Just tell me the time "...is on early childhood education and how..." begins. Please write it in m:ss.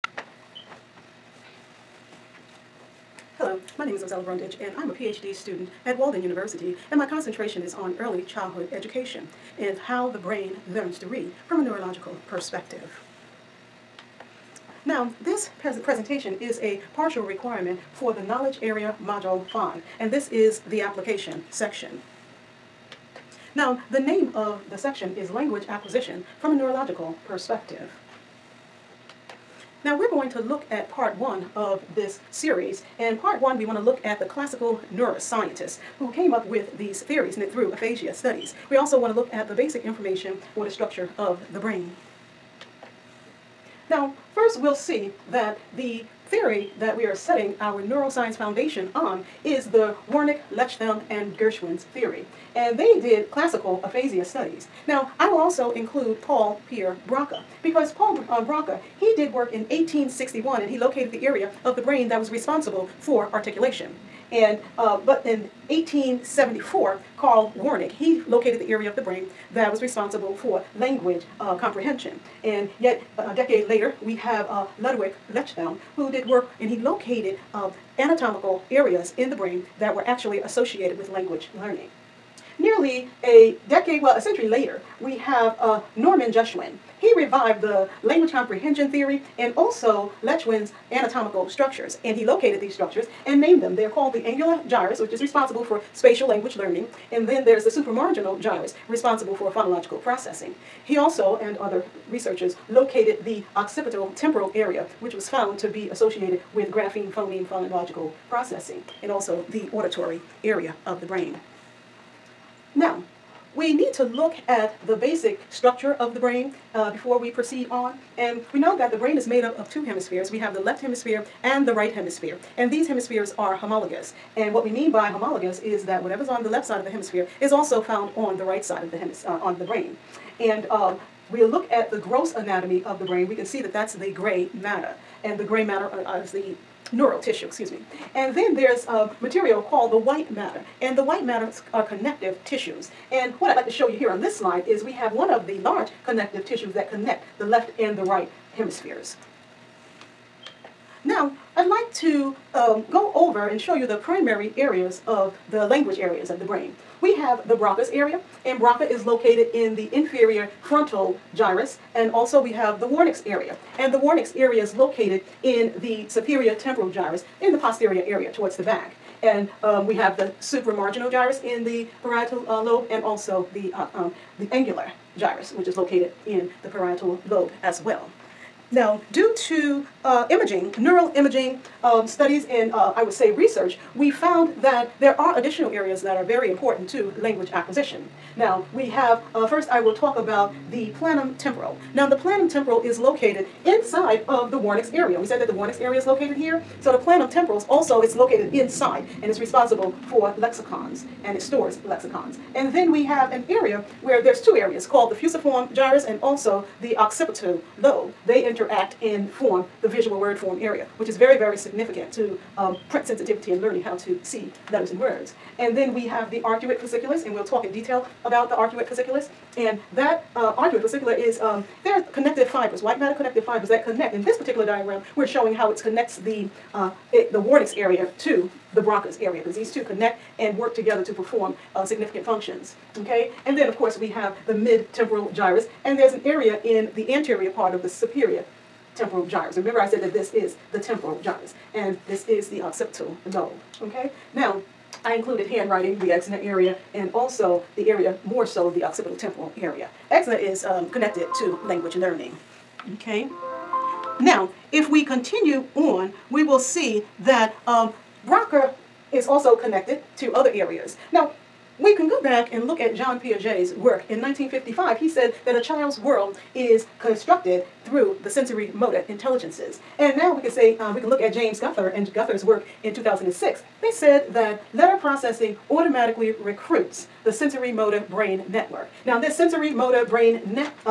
0:07.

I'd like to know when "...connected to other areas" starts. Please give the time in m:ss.
4:19.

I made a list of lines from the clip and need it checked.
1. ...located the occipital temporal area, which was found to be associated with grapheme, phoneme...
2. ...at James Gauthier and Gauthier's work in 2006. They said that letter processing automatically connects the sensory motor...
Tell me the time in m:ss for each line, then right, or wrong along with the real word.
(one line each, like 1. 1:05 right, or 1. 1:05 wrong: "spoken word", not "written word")
1. 1:42 right
2. 4:31 wrong: "recruits", not "connects".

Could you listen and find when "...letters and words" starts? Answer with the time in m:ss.
3:34.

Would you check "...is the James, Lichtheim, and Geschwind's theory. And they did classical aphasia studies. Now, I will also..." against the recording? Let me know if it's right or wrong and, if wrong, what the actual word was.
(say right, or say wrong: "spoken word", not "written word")
wrong: "Wernicke", not "James".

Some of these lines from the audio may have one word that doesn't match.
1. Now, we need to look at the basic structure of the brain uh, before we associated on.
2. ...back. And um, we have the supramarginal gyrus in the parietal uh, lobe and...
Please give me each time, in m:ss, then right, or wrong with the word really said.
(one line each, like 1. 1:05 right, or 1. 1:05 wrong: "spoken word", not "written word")
1. 1:52 wrong: "proceed", not "associated"
2. 2:48 right.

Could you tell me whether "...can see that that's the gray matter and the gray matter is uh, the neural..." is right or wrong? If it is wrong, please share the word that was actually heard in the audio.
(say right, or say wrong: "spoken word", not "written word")
right.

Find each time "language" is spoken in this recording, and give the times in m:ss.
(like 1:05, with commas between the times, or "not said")
0:25, 1:10, 1:21, 1:28, 1:36, 2:35, 3:07, 4:11.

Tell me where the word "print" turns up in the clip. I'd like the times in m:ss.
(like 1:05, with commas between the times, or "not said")
3:32.